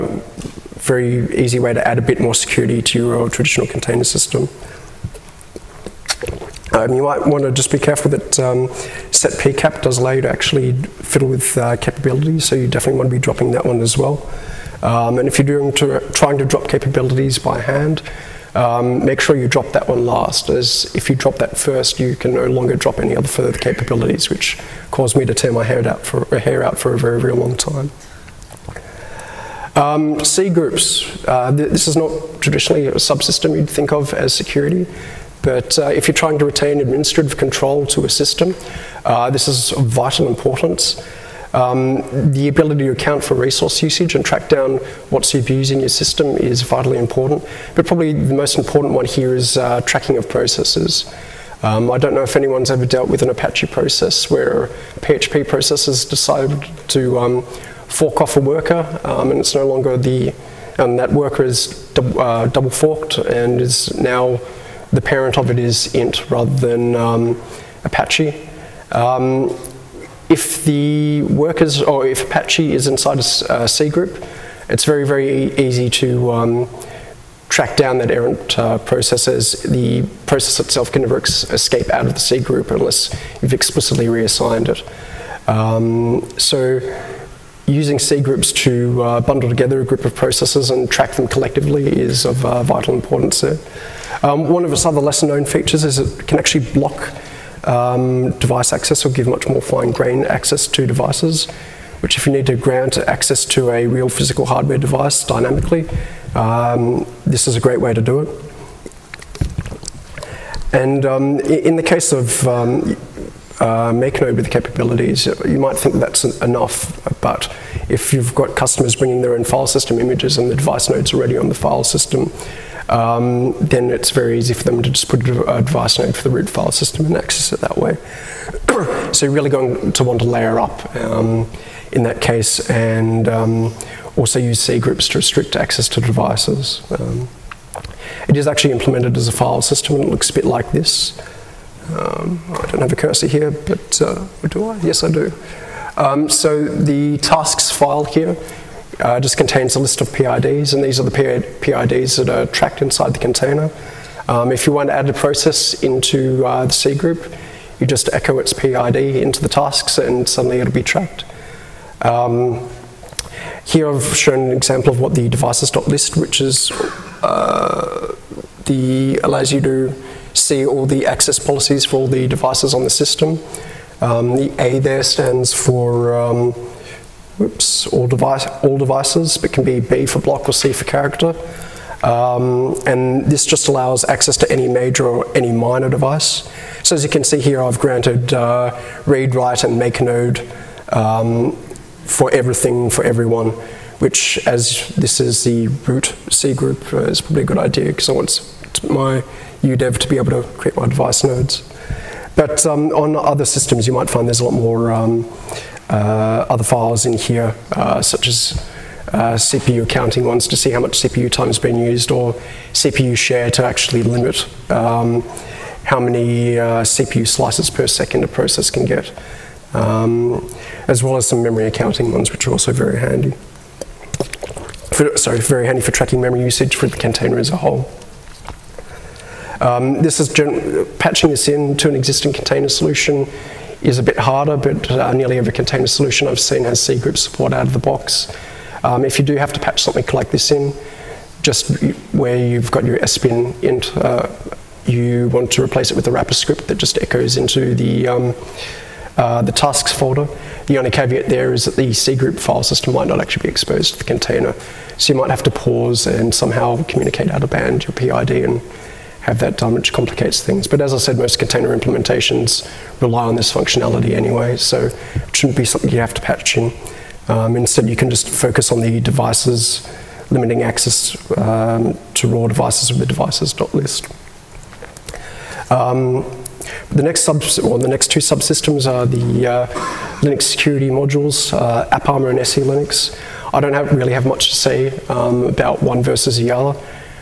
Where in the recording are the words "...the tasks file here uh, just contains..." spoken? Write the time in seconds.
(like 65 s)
146 s.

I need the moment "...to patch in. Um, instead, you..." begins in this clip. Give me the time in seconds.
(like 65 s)
266 s.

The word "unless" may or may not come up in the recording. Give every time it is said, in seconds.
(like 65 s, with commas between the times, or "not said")
82 s.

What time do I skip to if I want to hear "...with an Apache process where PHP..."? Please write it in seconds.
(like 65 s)
53 s.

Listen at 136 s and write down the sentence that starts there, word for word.
Um, it is actually implemented as a file system and it looks a bit like this.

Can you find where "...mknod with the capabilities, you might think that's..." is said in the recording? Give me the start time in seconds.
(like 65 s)
113 s.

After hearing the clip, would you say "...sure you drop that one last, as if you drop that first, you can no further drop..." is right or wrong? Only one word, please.
wrong.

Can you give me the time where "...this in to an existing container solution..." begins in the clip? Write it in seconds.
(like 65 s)
231 s.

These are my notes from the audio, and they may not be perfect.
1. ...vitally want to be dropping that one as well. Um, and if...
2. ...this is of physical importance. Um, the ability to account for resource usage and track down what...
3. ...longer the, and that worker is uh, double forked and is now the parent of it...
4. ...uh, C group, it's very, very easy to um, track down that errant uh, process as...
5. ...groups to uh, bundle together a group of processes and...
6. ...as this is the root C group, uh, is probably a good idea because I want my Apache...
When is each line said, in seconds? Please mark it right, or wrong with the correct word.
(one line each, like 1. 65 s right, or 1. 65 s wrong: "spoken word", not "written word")
1. 12 s wrong: "definitely", not "vitally"
2. 39 s wrong: "vital", not "physical"
3. 59 s right
4. 73 s right
5. 88 s right
6. 194 s wrong: "UDEV", not "Apache".